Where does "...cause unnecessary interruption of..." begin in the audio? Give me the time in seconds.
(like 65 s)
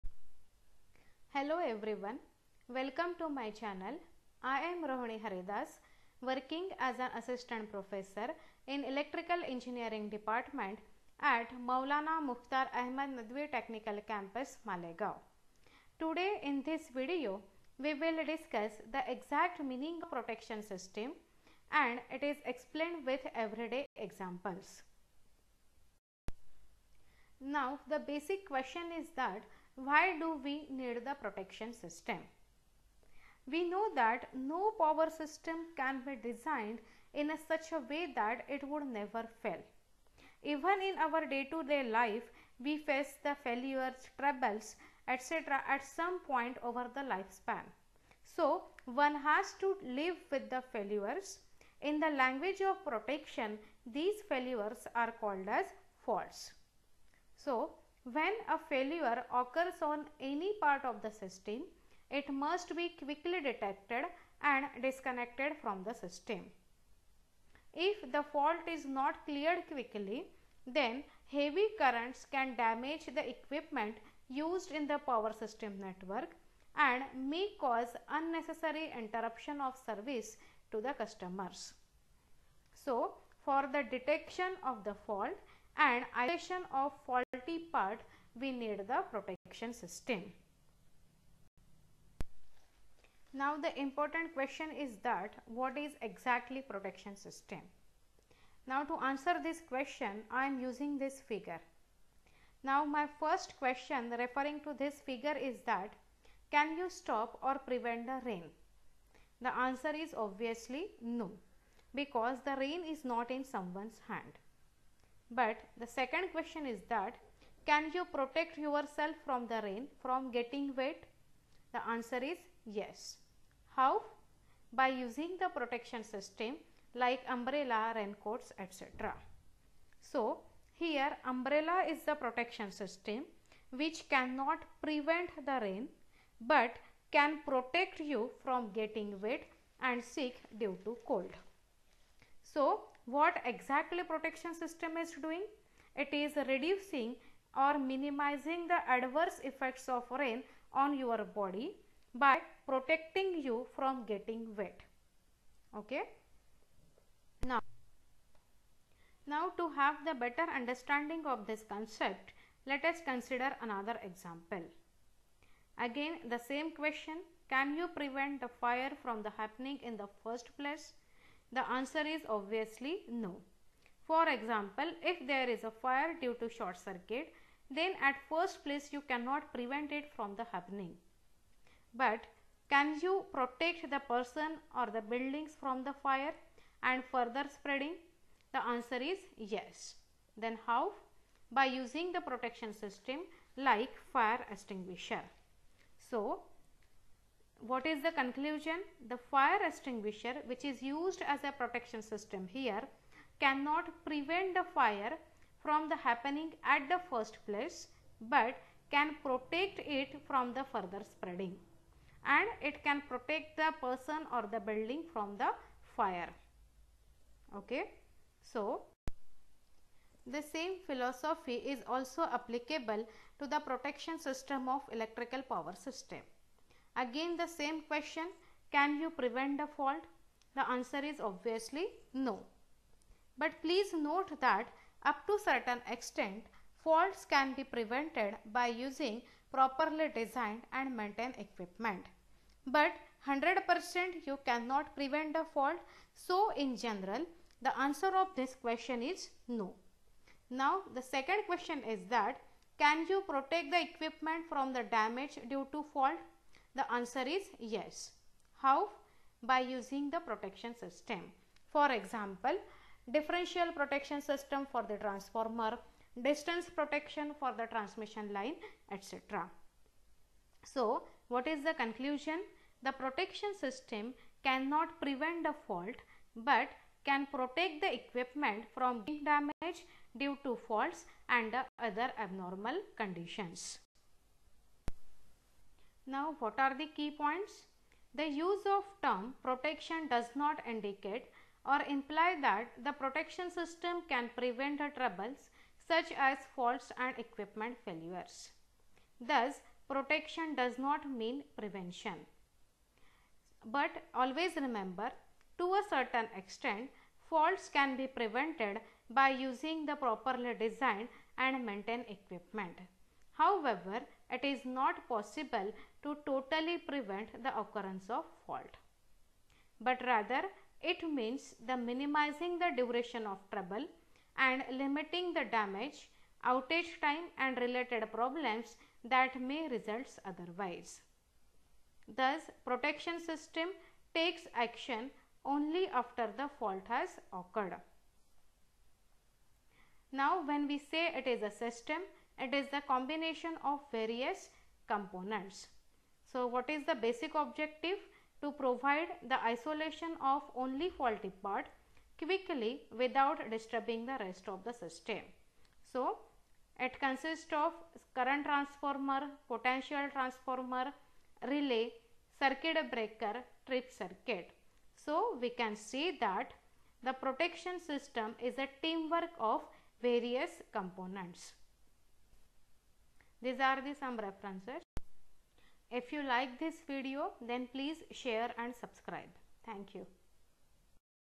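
77 s.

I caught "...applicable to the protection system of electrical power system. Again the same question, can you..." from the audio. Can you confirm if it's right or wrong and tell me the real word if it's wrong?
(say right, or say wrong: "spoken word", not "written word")
right.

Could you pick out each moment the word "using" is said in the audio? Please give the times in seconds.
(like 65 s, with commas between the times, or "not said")
100 s, 124 s, 191 s, 238 s, 259 s, 309 s.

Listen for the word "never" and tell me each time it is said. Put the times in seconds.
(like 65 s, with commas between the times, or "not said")
38 s.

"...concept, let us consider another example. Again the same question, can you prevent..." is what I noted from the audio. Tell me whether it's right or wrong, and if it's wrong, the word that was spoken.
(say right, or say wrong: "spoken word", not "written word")
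right.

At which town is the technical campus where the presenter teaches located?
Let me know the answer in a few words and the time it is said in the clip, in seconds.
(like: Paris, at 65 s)
Malegaon, at 14 s.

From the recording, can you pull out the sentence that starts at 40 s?
Even in our day to day life, we face the failures, troubles, etc.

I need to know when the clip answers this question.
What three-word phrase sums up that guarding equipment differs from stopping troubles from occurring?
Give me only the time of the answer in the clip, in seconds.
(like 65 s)
299 s.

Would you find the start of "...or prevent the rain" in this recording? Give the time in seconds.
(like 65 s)
107 s.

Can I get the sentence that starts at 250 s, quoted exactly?
Now the second question is that, can you protect the equipment from the damage due to fault?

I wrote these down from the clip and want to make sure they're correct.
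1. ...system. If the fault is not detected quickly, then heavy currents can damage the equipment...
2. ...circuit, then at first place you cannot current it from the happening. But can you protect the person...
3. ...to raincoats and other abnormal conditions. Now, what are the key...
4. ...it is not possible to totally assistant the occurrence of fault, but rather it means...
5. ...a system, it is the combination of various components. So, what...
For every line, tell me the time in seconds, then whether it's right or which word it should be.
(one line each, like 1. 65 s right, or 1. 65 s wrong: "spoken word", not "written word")
1. 65 s wrong: "cleared", not "detected"
2. 176 s wrong: "prevent", not "current"
3. 280 s wrong: "faults", not "raincoats"
4. 314 s wrong: "prevent", not "assistant"
5. 341 s right.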